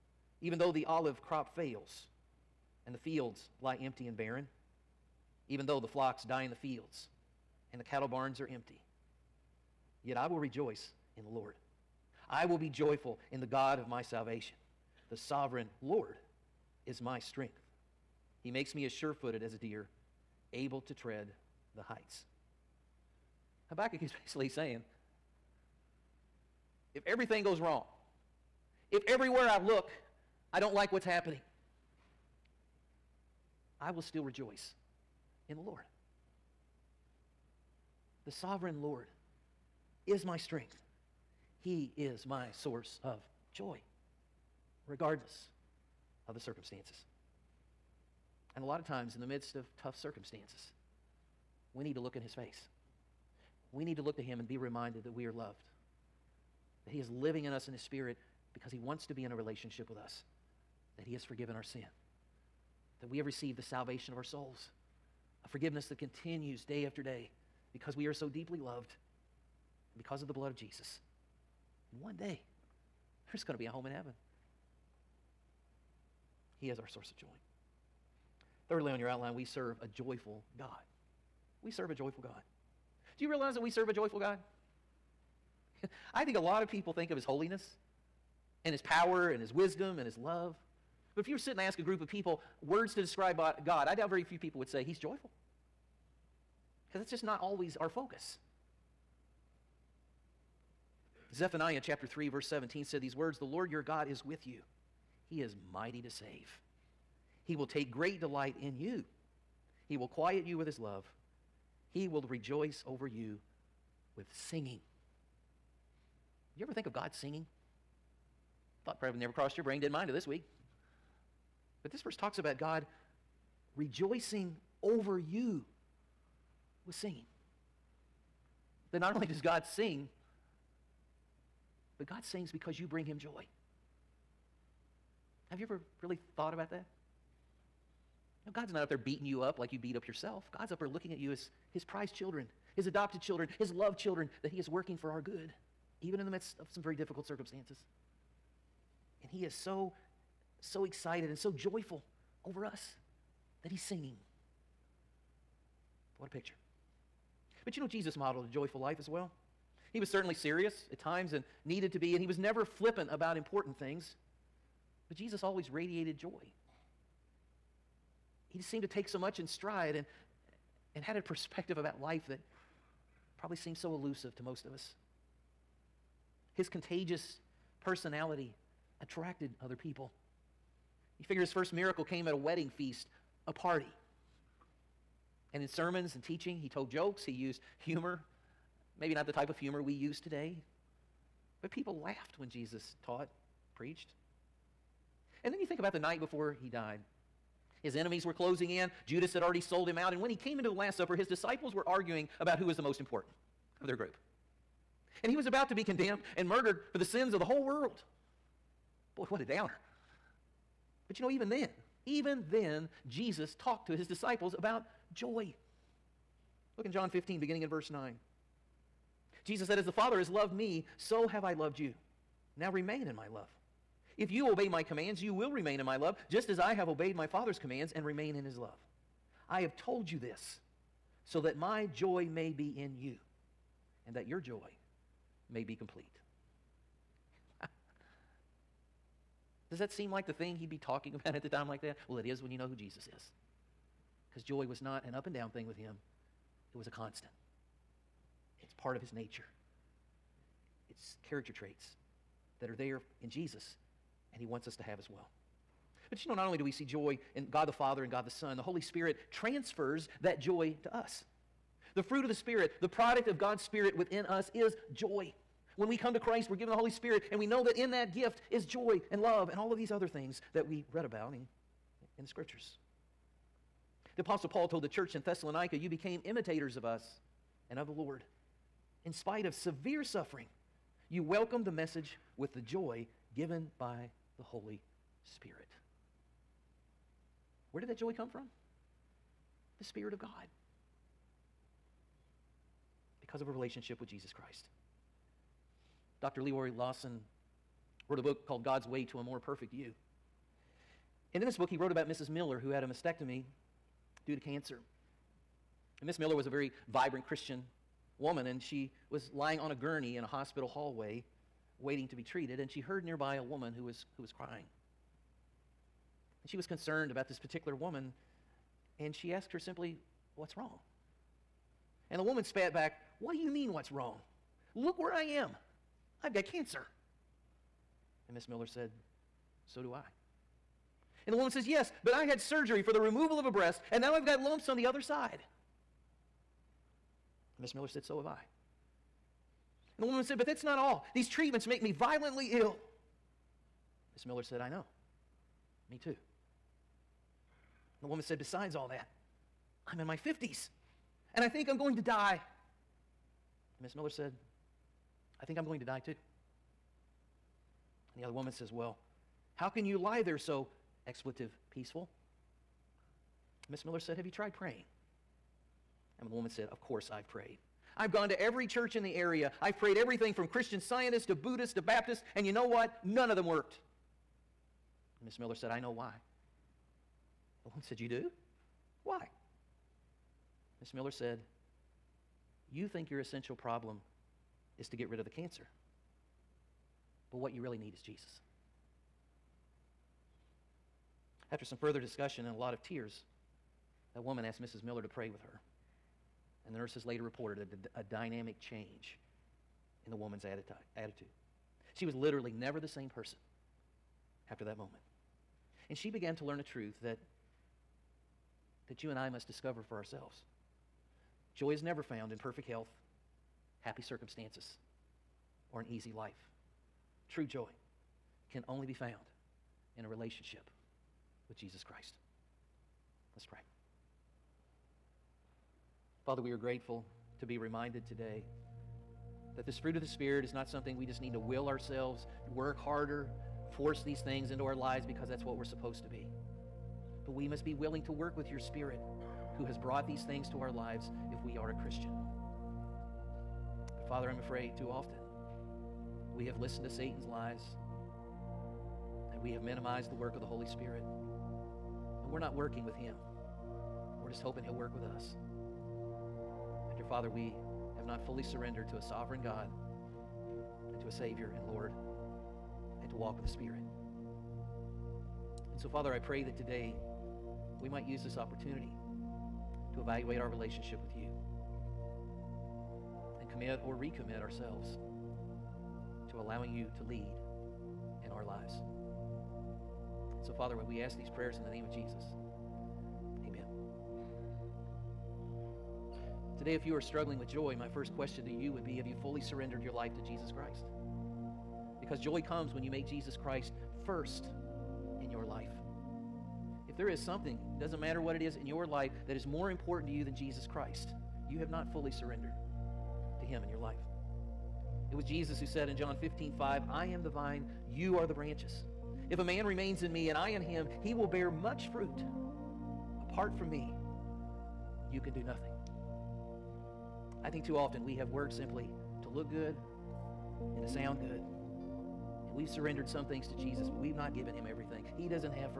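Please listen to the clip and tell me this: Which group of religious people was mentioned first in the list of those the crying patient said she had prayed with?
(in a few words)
Christian scientists.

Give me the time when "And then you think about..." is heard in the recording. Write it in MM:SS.
03:15.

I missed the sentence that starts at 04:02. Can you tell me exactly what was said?
Well, it is when you know who Jesus is.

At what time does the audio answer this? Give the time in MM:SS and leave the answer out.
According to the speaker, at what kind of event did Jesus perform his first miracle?
03:02.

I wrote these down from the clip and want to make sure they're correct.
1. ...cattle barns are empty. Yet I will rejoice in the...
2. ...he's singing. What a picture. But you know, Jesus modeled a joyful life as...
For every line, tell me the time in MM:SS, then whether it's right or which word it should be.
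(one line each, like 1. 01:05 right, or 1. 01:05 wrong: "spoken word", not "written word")
1. 00:07 right
2. 02:33 right.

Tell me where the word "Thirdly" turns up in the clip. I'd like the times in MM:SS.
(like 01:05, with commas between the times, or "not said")
01:18.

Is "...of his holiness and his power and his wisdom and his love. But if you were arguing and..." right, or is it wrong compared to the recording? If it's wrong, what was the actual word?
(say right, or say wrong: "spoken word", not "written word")
wrong: "sitting", not "arguing".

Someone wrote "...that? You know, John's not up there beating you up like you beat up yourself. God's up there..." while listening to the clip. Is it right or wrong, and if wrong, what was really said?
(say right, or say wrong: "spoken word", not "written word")
wrong: "God", not "John".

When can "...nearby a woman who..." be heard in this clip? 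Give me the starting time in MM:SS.
05:13.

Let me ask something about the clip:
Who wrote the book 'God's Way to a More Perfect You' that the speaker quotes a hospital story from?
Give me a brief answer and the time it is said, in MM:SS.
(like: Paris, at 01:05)
Dr. Leroy Lawson, at 04:56.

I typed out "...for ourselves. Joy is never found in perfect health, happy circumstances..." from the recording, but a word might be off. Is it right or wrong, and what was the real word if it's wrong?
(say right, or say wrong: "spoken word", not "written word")
right.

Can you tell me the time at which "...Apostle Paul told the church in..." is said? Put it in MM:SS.
04:34.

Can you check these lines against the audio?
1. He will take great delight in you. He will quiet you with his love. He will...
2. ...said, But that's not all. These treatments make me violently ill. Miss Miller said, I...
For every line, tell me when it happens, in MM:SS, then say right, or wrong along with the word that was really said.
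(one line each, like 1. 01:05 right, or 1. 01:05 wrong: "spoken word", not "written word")
1. 01:47 right
2. 05:40 right.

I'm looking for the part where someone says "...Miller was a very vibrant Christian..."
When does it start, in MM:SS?
05:06.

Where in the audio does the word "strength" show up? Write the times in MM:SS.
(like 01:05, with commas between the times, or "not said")
00:17, 00:40.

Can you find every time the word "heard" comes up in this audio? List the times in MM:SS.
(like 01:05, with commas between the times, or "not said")
05:12.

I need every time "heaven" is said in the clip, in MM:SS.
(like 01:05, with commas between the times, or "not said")
01:13.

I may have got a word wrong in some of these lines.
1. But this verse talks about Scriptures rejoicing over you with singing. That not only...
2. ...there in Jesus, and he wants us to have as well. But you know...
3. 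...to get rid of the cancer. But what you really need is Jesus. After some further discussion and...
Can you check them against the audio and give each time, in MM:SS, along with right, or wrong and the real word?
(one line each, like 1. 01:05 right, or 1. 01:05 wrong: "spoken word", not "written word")
1. 02:01 wrong: "God", not "Scriptures"
2. 04:12 right
3. 06:24 right.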